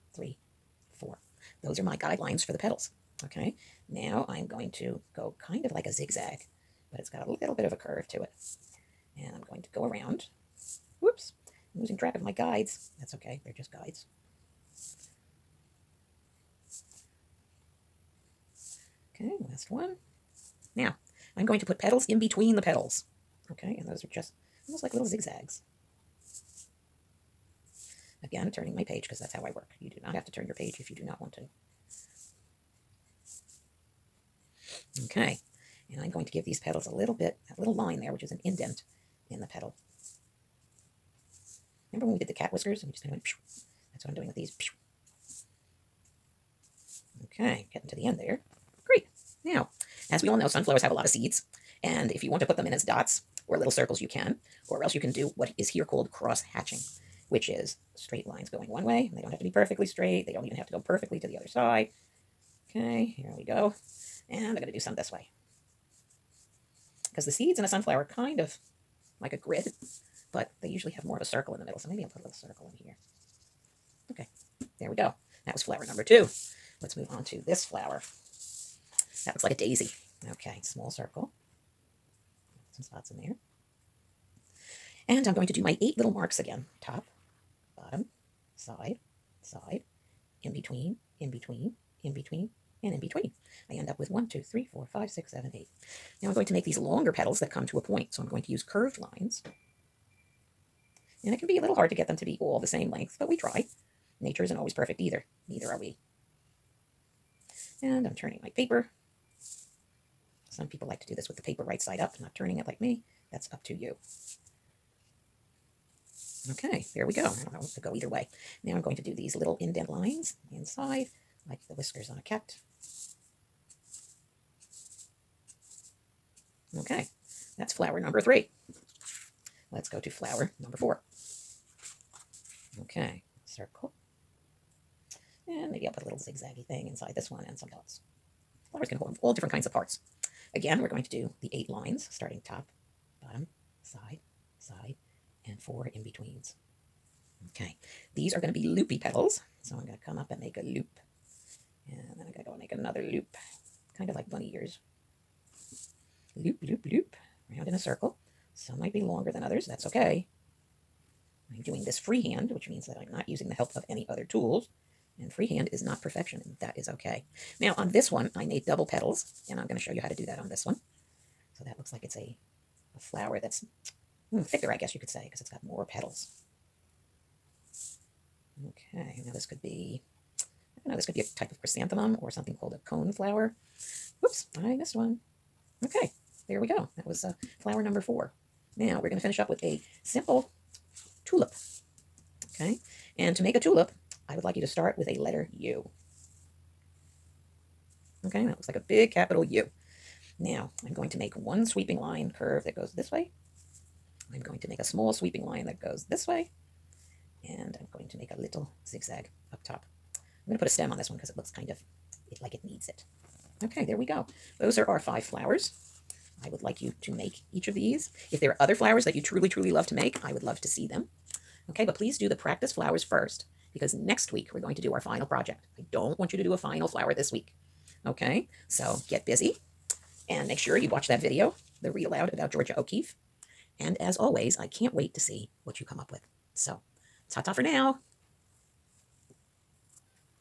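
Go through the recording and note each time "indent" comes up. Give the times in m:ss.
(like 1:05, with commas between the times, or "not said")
0:38, 1:59.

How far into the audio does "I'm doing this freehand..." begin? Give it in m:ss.
2:41.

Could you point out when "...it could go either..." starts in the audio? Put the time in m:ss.
1:57.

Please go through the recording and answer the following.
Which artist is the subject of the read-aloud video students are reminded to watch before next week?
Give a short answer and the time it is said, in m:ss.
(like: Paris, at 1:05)
Georgia O'Keeffe, at 3:52.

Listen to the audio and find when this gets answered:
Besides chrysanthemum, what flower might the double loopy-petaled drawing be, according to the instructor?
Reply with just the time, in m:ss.
3:02.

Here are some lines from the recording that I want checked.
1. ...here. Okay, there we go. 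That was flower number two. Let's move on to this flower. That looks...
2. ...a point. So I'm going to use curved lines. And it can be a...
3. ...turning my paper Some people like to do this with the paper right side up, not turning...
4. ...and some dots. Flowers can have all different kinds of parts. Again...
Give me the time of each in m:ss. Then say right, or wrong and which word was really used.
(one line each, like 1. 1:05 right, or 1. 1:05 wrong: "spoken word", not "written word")
1. 1:12 right
2. 1:37 right
3. 1:48 right
4. 2:17 right.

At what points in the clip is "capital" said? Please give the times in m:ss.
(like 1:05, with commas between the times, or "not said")
3:19.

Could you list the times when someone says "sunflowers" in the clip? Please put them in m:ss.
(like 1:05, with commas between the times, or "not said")
0:50, 1:07.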